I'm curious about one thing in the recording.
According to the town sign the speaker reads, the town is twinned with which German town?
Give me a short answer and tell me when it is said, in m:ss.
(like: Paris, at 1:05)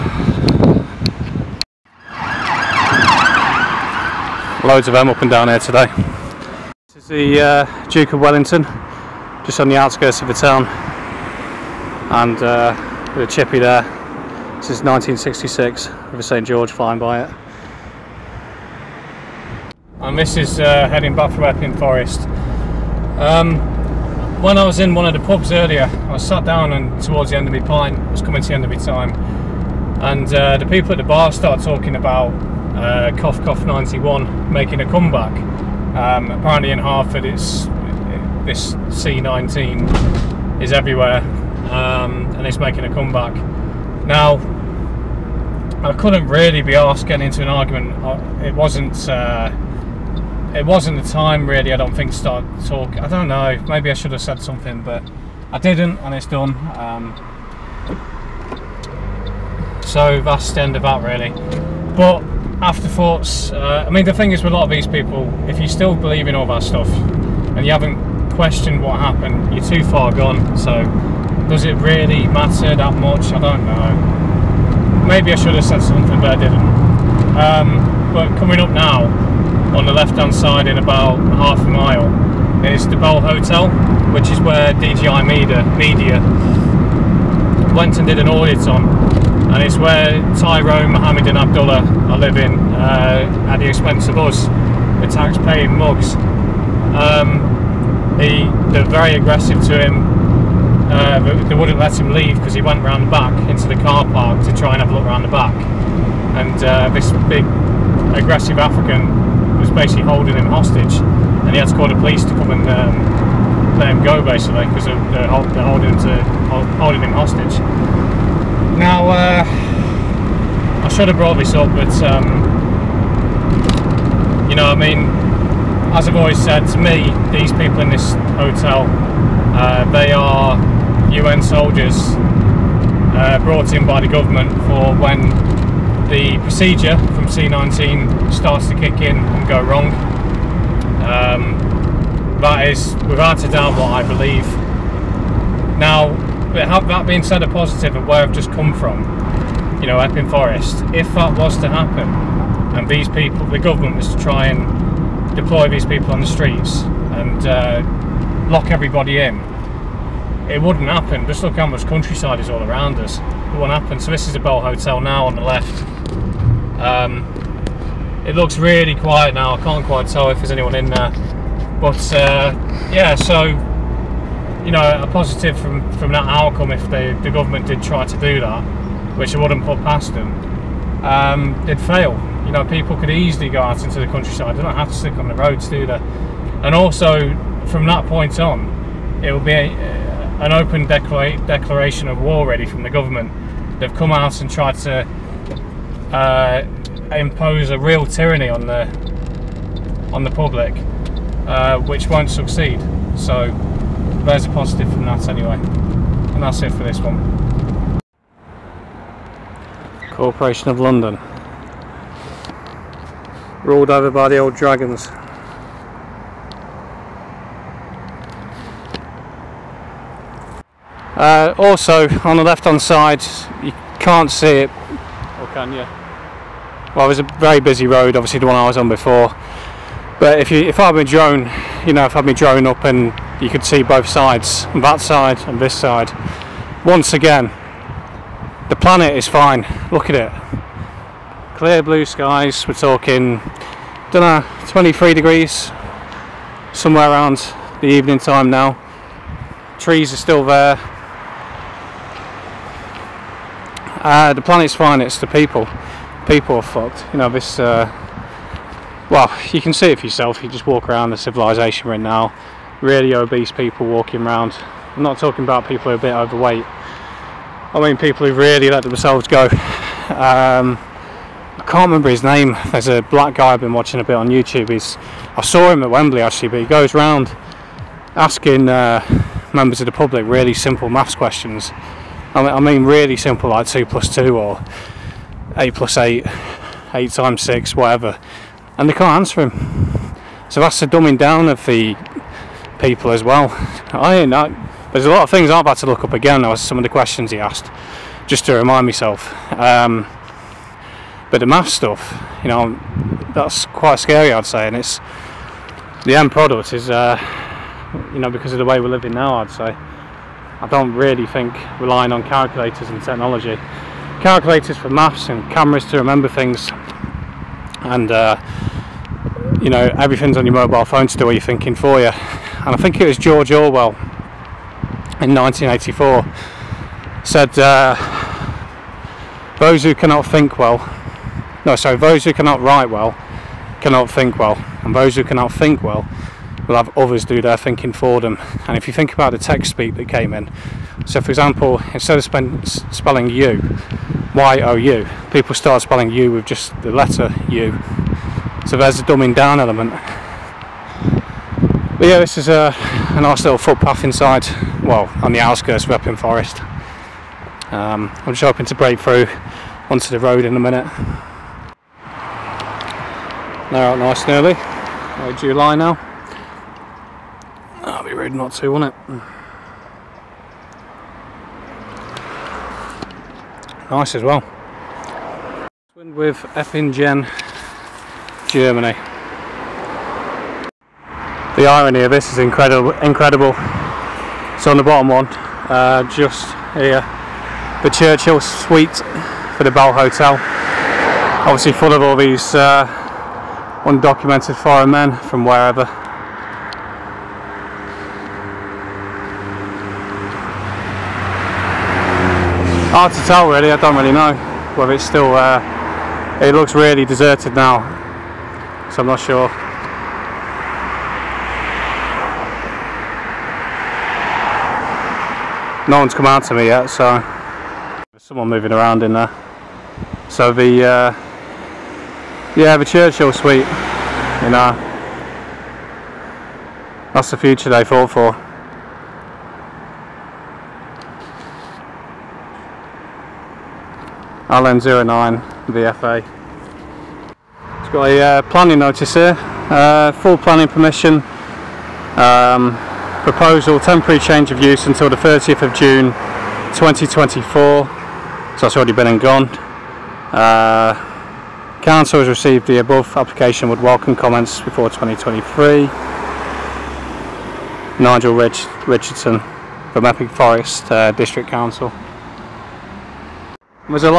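Eppingen, at 6:16.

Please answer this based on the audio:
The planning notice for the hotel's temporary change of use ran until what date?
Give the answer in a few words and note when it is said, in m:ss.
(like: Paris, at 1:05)
30 June 2024, at 7:25.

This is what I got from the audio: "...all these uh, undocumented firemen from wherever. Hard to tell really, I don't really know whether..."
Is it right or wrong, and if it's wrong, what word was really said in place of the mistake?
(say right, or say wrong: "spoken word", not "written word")
right.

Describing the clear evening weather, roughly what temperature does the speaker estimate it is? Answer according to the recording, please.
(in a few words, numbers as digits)
23 degrees.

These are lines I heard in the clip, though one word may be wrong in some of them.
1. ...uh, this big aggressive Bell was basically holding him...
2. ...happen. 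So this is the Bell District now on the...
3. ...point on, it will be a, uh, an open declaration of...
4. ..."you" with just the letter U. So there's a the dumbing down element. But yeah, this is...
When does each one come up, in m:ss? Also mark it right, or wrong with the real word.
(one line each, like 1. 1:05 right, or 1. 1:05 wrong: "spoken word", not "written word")
1. 1:46 wrong: "African", not "Bell"
2. 2:43 wrong: "Hotel", not "District"
3. 3:08 right
4. 5:46 right.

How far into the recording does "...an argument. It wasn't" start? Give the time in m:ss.
0:47.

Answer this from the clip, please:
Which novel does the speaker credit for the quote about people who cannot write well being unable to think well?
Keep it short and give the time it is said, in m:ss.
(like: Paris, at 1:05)
1984, at 5:25.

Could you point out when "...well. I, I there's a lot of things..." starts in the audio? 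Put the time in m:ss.
4:53.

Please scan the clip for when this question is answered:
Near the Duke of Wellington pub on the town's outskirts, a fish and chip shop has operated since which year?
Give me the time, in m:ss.
0:14.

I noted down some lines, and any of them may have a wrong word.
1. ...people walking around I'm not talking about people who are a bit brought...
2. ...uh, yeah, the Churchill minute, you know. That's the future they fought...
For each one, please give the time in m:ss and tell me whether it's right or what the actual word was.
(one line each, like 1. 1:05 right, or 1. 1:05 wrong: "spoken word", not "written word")
1. 4:23 wrong: "overweight", not "brought"
2. 7:00 wrong: "suite", not "minute".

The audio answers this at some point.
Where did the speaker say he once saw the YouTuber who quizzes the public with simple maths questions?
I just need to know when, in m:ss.
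4:35.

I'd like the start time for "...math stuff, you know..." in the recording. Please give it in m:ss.
5:01.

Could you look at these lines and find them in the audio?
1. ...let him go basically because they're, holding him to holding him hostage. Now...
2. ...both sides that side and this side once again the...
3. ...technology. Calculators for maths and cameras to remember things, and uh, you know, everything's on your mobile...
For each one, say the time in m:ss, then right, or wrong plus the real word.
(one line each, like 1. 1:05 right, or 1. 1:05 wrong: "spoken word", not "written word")
1. 1:53 right
2. 3:53 right
3. 5:13 right.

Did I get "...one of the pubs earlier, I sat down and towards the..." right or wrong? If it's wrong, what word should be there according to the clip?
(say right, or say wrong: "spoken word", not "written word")
right.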